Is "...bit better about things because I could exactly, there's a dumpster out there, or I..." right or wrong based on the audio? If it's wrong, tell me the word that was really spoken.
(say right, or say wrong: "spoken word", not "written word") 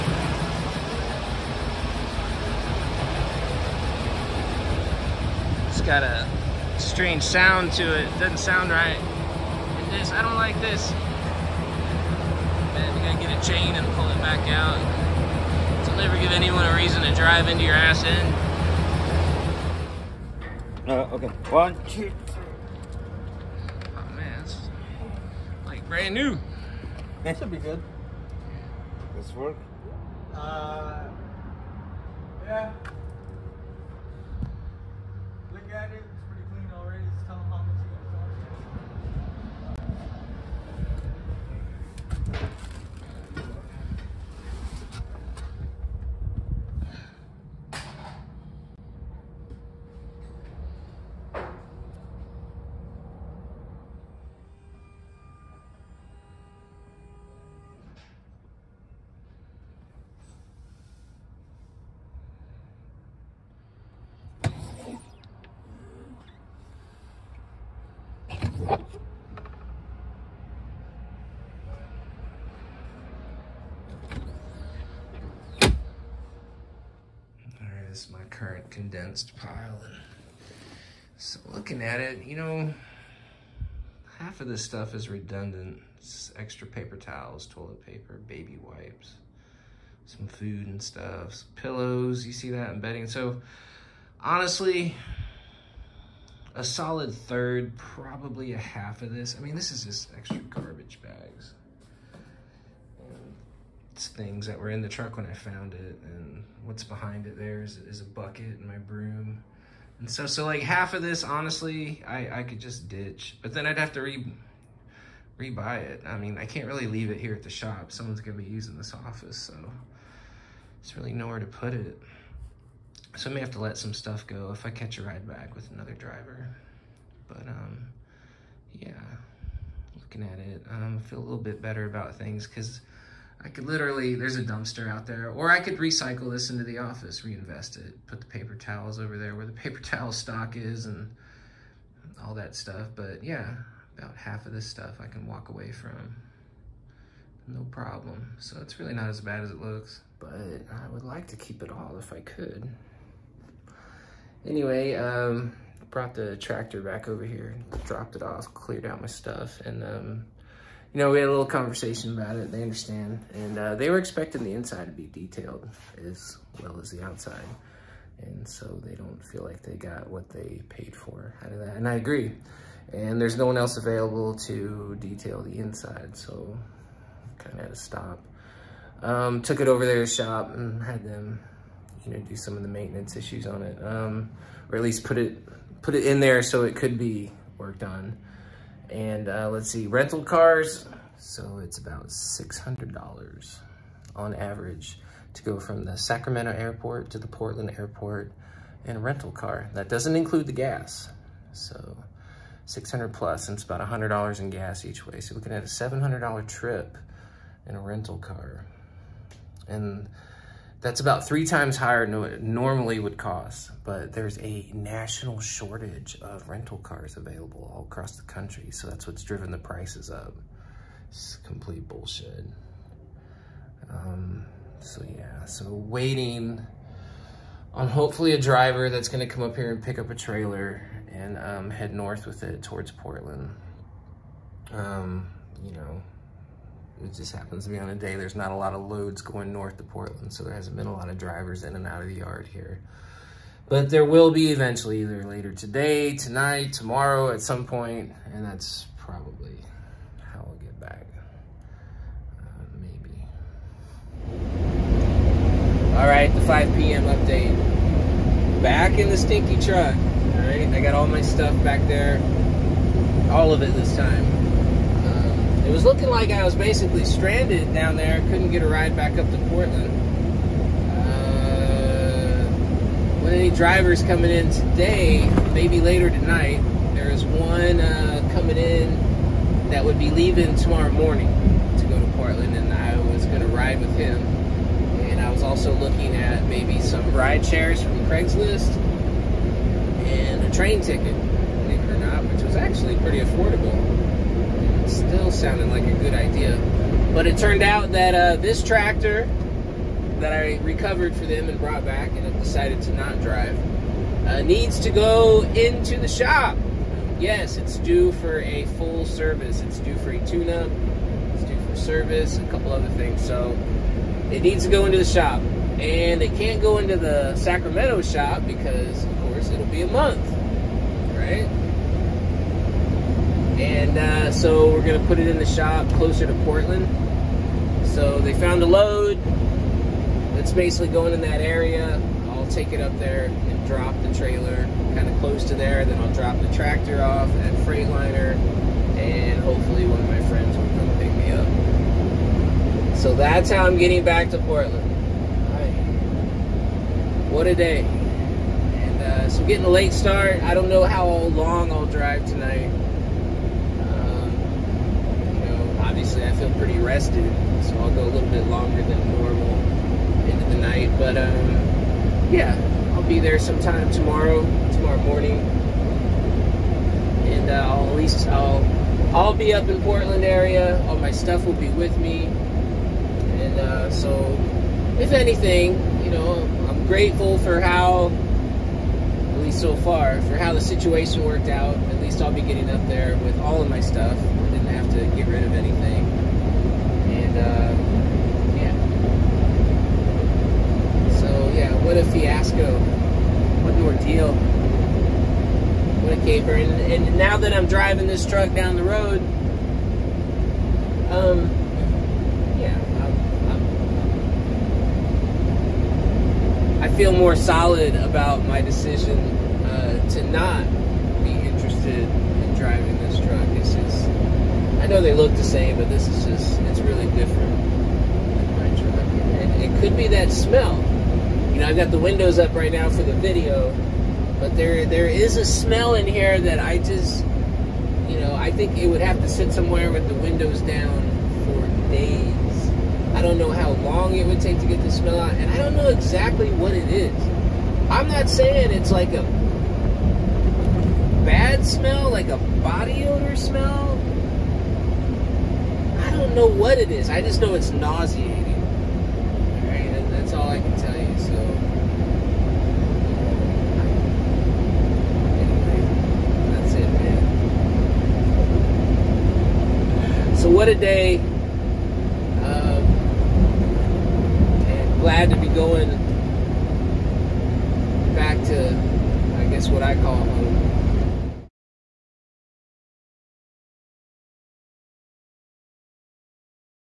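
wrong: "literally", not "exactly".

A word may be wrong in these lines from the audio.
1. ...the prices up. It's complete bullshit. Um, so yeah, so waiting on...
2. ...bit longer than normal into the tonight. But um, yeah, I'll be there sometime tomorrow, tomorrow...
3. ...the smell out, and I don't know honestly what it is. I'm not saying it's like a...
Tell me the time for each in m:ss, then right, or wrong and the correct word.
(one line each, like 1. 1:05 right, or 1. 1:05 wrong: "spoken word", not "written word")
1. 3:39 right
2. 5:58 wrong: "night", not "tonight"
3. 7:14 wrong: "exactly", not "honestly".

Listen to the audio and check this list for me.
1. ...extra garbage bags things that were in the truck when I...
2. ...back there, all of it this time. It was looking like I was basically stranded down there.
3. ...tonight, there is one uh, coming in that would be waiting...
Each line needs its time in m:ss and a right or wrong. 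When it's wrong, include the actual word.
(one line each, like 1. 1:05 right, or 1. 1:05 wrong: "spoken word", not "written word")
1. 1:40 right
2. 4:21 right
3. 4:36 wrong: "leaving", not "waiting".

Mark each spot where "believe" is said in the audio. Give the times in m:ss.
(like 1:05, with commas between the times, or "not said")
4:51.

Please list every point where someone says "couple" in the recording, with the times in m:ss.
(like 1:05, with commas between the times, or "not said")
5:12.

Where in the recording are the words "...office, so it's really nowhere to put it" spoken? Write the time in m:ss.
1:58.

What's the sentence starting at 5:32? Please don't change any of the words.
I'll take it up there and drop the trailer kind of close to there.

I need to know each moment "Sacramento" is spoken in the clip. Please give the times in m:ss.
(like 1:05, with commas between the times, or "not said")
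3:15, 5:17.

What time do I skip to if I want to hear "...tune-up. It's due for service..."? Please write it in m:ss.
5:10.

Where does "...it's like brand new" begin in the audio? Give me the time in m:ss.
0:24.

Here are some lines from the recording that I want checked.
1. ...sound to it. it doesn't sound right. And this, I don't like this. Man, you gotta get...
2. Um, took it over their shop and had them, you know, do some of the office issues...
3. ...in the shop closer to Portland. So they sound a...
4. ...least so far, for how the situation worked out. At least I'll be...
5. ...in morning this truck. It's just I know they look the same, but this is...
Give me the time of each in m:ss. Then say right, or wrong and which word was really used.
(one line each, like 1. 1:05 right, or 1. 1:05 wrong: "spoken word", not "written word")
1. 0:07 right
2. 2:59 wrong: "maintenance", not "office"
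3. 5:25 wrong: "found", not "sound"
4. 6:19 right
5. 6:51 wrong: "driving", not "morning".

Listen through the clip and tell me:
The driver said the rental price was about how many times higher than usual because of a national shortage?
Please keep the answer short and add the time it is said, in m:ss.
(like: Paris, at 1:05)
3, at 3:31.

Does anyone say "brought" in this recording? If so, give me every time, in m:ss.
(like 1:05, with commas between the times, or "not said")
2:35, 5:01.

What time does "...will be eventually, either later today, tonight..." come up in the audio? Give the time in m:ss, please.
4:04.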